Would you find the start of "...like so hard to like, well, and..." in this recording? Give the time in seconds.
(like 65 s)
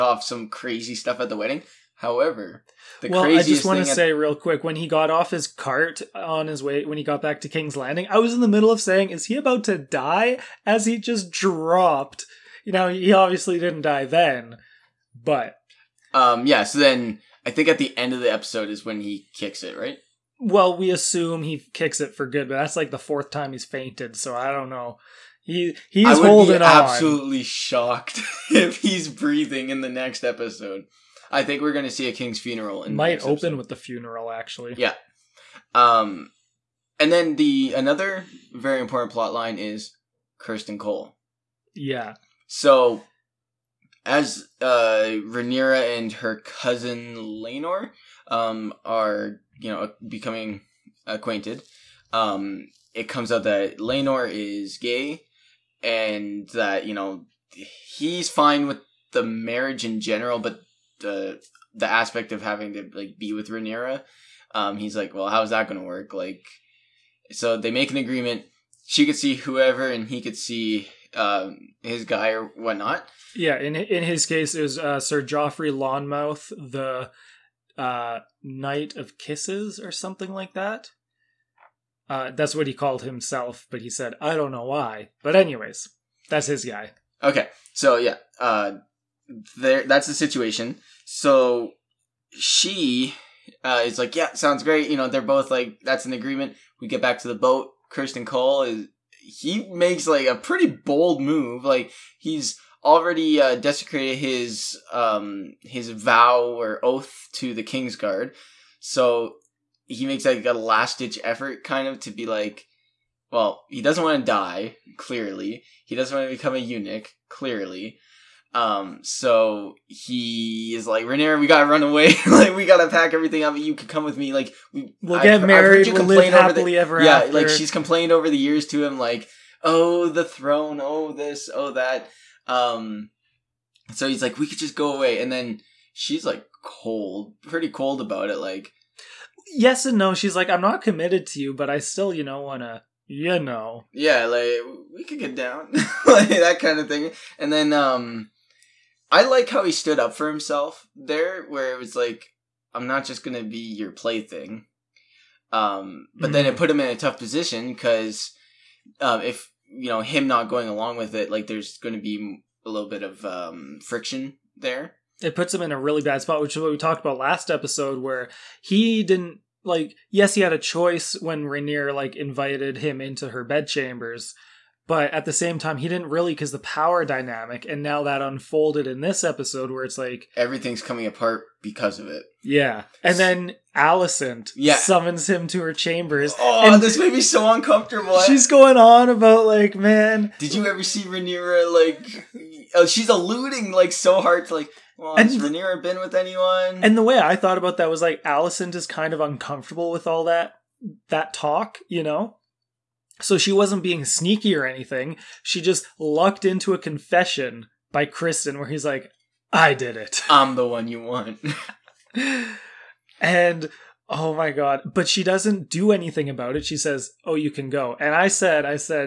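193 s.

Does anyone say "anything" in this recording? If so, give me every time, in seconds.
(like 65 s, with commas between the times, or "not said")
204 s, 215 s.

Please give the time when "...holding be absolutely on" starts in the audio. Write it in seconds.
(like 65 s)
26 s.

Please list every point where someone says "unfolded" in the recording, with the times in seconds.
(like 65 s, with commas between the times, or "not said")
178 s.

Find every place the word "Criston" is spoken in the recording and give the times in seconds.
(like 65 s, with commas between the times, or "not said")
40 s, 97 s, 208 s.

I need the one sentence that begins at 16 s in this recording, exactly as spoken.
So then I think at the end of the episode is when he kicks it, right?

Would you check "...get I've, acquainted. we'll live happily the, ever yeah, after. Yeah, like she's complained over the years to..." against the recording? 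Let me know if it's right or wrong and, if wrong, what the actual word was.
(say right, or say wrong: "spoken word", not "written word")
wrong: "married", not "acquainted".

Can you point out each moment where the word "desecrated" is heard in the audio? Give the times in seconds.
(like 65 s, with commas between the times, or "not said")
103 s.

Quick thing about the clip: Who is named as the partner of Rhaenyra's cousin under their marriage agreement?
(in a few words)
Sir Joffrey Lonmouth.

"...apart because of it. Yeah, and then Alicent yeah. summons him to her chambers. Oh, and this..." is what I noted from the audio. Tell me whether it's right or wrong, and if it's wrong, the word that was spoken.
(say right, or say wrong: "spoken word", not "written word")
right.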